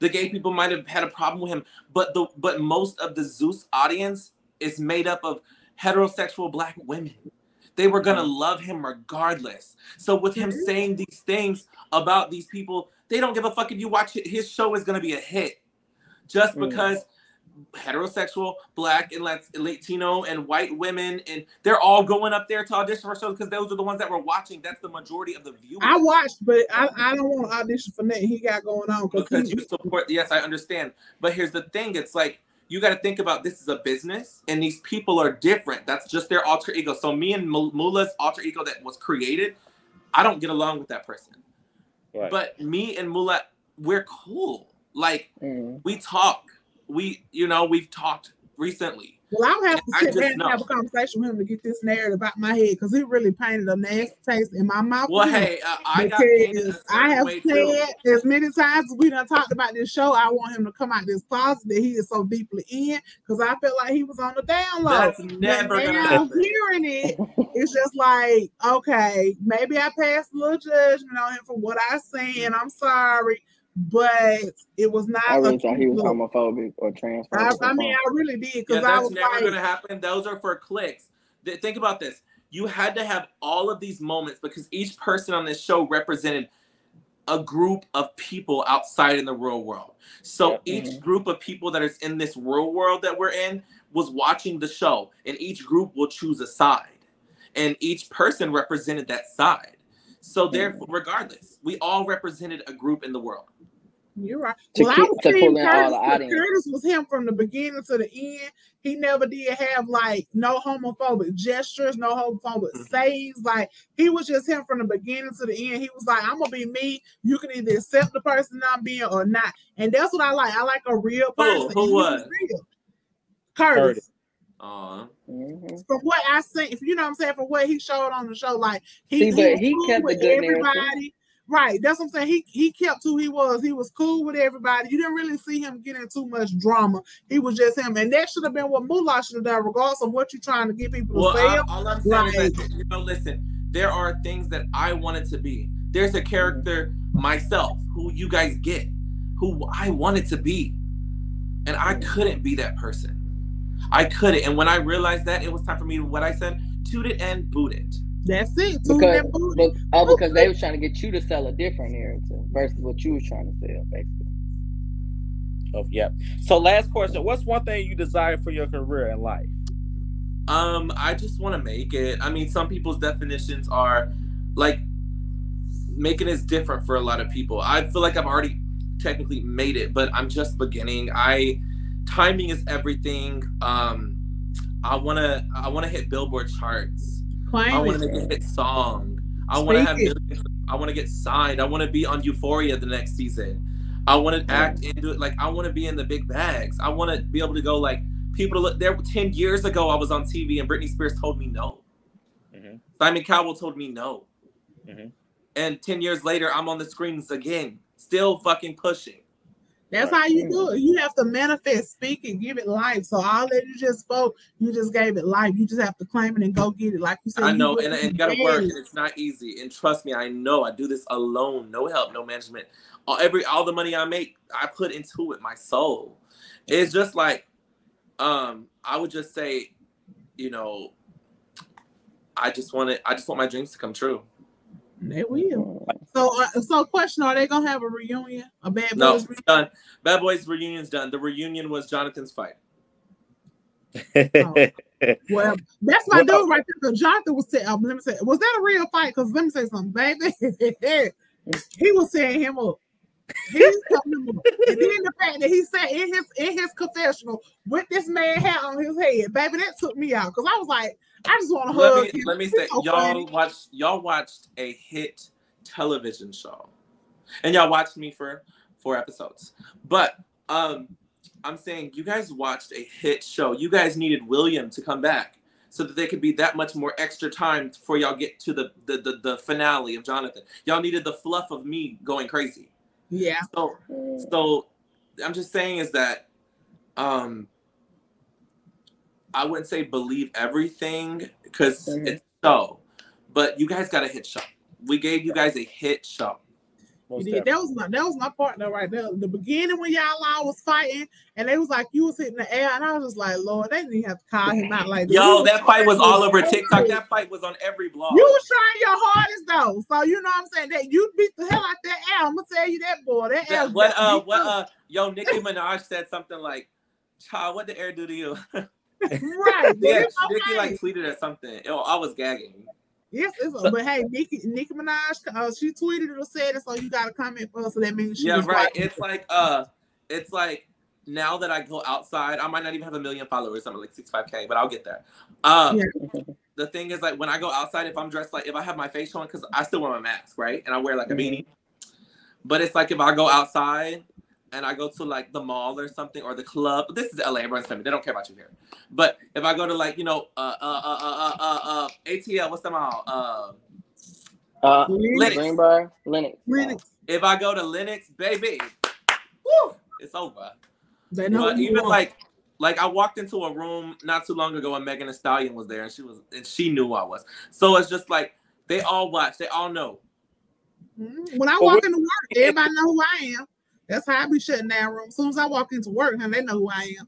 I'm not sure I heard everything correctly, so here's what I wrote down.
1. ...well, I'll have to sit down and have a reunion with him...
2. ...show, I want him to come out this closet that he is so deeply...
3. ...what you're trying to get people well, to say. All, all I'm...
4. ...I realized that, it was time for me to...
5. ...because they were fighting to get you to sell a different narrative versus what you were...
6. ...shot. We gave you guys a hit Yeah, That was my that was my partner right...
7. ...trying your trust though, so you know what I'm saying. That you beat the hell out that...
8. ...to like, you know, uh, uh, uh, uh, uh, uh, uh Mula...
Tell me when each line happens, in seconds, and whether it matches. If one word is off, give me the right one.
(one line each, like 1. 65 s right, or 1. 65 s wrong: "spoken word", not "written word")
1. 49 s wrong: "conversation", not "reunion"
2. 59 s right
3. 140 s right
4. 154 s right
5. 160 s wrong: "trying", not "fighting"
6. 294 s right
7. 308 s wrong: "hardest", not "trust"
8. 349 s wrong: "ATL", not "Mula".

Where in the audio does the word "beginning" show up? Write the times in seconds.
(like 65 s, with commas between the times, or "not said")
107 s, 114 s, 180 s, 299 s.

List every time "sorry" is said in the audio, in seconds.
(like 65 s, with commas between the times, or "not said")
72 s.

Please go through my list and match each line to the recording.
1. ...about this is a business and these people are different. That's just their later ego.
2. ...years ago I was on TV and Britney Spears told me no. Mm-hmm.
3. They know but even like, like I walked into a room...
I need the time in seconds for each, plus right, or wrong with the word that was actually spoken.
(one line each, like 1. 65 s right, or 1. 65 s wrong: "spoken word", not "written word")
1. 33 s wrong: "alter", not "later"
2. 199 s right
3. 361 s right.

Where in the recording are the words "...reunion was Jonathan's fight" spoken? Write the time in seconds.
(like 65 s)
241 s.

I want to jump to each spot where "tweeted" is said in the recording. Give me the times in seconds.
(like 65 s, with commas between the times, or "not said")
320 s, 325 s.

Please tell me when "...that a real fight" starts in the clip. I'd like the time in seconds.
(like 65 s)
248 s.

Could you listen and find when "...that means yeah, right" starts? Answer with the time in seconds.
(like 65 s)
327 s.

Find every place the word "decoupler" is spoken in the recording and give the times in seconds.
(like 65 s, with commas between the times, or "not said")
not said.